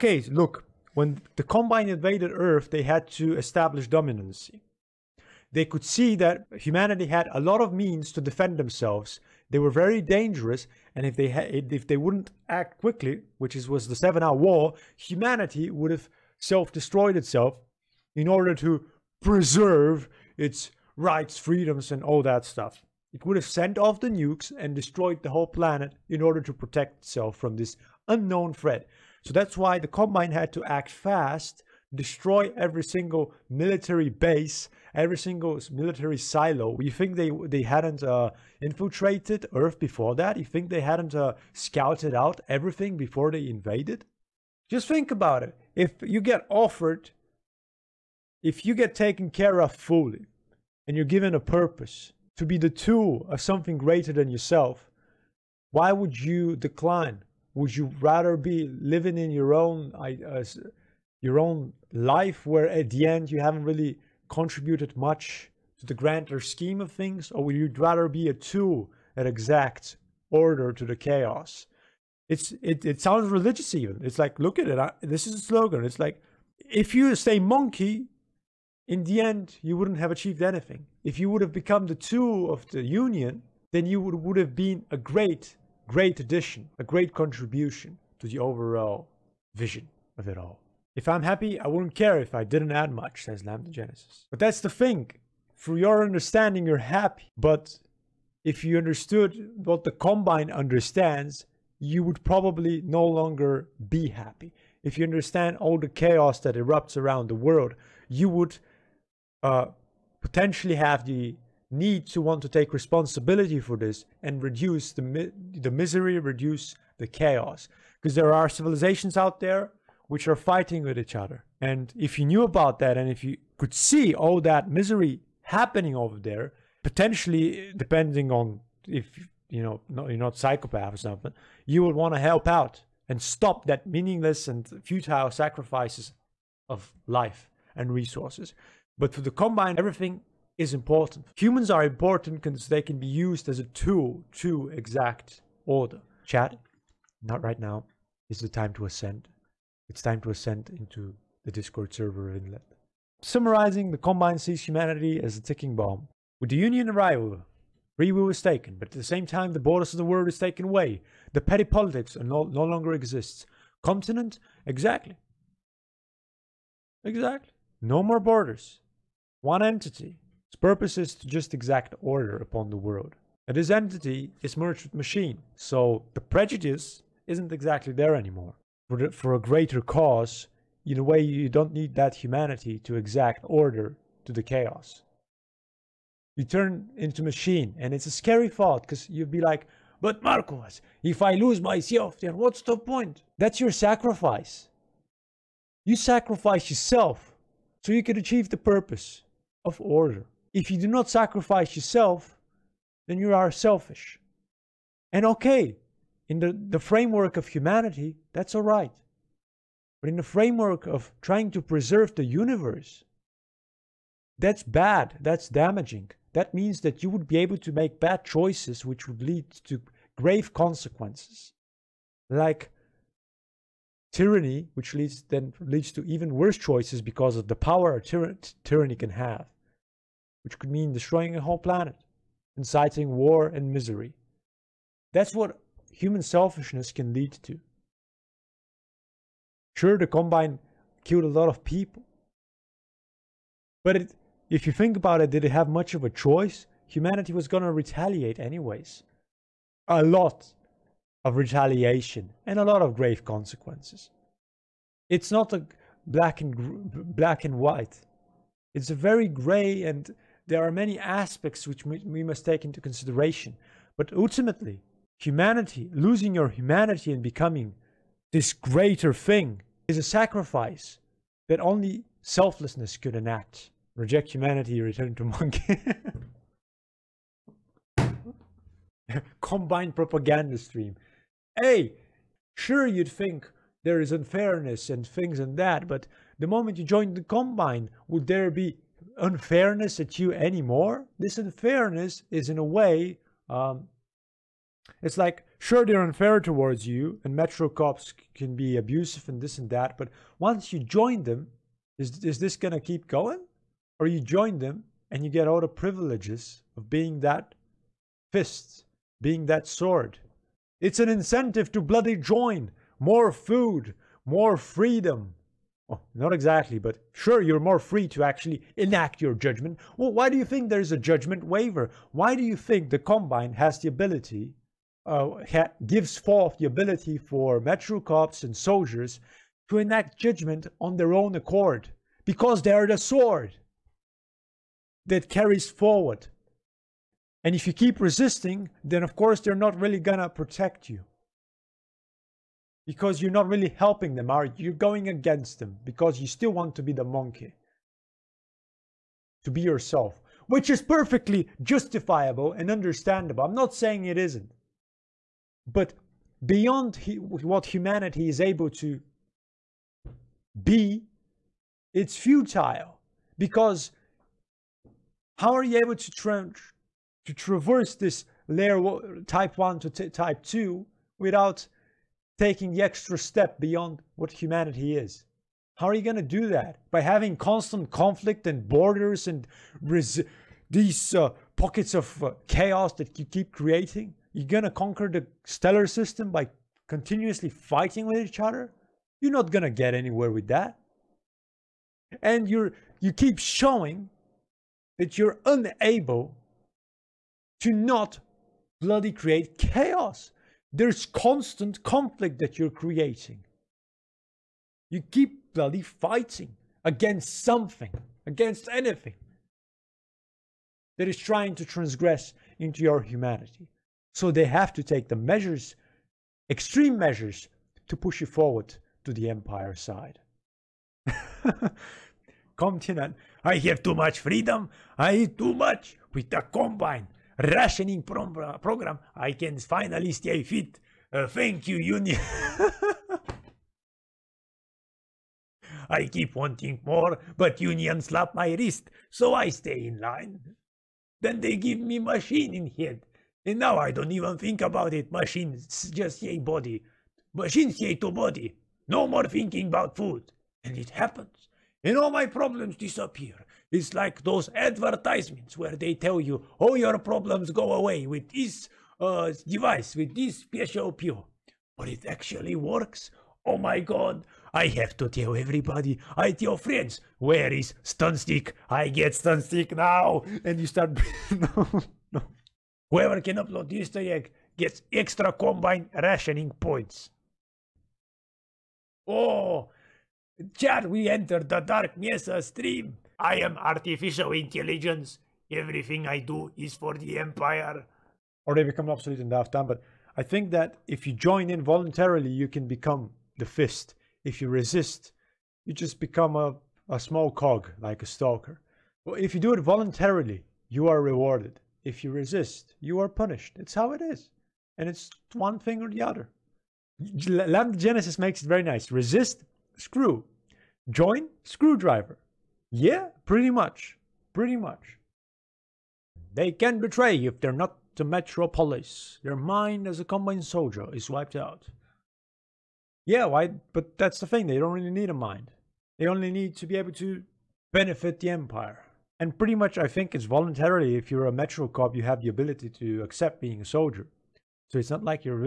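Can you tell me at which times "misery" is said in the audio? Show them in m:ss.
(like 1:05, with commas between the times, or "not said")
1:55, 2:04, 3:53.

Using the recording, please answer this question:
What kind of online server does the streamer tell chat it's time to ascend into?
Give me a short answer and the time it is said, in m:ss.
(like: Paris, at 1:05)
Discord, at 2:31.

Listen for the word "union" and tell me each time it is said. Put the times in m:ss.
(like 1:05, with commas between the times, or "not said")
1:22, 2:36, 7:11, 7:17.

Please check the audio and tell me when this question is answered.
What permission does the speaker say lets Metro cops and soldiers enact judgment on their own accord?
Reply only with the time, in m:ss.
5:20.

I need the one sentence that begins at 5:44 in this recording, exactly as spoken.
You're going against them because you still want to be the monkey, to be yourself, which is perfectly justifiable and understandable.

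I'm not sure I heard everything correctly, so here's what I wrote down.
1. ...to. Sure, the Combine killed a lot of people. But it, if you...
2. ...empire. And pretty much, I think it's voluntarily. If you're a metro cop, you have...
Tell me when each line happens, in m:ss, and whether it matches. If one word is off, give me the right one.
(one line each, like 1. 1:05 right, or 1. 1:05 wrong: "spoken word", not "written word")
1. 3:57 right
2. 8:48 right.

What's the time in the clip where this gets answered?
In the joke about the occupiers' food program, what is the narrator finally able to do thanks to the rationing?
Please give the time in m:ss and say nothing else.
7:10.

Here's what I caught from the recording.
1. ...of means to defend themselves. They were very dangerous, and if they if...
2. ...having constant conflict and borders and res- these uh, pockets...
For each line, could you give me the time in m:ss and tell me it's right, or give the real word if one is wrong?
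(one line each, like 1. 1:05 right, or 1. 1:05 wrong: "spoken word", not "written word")
1. 0:07 right
2. 6:17 right.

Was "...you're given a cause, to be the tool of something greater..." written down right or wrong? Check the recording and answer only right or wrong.
wrong.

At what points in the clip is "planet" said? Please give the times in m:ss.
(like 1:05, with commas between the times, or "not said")
0:25, 3:51.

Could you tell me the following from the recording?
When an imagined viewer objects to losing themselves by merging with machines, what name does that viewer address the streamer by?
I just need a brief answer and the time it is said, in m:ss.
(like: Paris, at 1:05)
Marcos, at 3:10.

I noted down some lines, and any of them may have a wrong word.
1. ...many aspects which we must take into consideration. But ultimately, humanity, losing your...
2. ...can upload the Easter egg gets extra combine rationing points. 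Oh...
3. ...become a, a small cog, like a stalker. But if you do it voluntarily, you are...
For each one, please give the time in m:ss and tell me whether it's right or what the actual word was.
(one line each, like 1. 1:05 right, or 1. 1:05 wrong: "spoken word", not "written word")
1. 4:20 right
2. 7:53 right
3. 8:15 right.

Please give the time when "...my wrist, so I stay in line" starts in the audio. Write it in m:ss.
7:18.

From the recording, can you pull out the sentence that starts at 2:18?
But for the Combine, everything is important.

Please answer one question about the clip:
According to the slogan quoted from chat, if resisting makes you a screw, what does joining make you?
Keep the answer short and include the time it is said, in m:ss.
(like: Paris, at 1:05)
screwdriver, at 8:31.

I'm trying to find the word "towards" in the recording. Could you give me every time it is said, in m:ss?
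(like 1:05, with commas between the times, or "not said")
4:56.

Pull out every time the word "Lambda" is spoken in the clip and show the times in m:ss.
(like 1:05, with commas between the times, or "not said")
1:33, 8:27.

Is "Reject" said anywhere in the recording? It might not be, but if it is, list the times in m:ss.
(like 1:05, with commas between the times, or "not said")
4:33.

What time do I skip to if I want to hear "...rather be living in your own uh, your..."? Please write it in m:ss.
0:57.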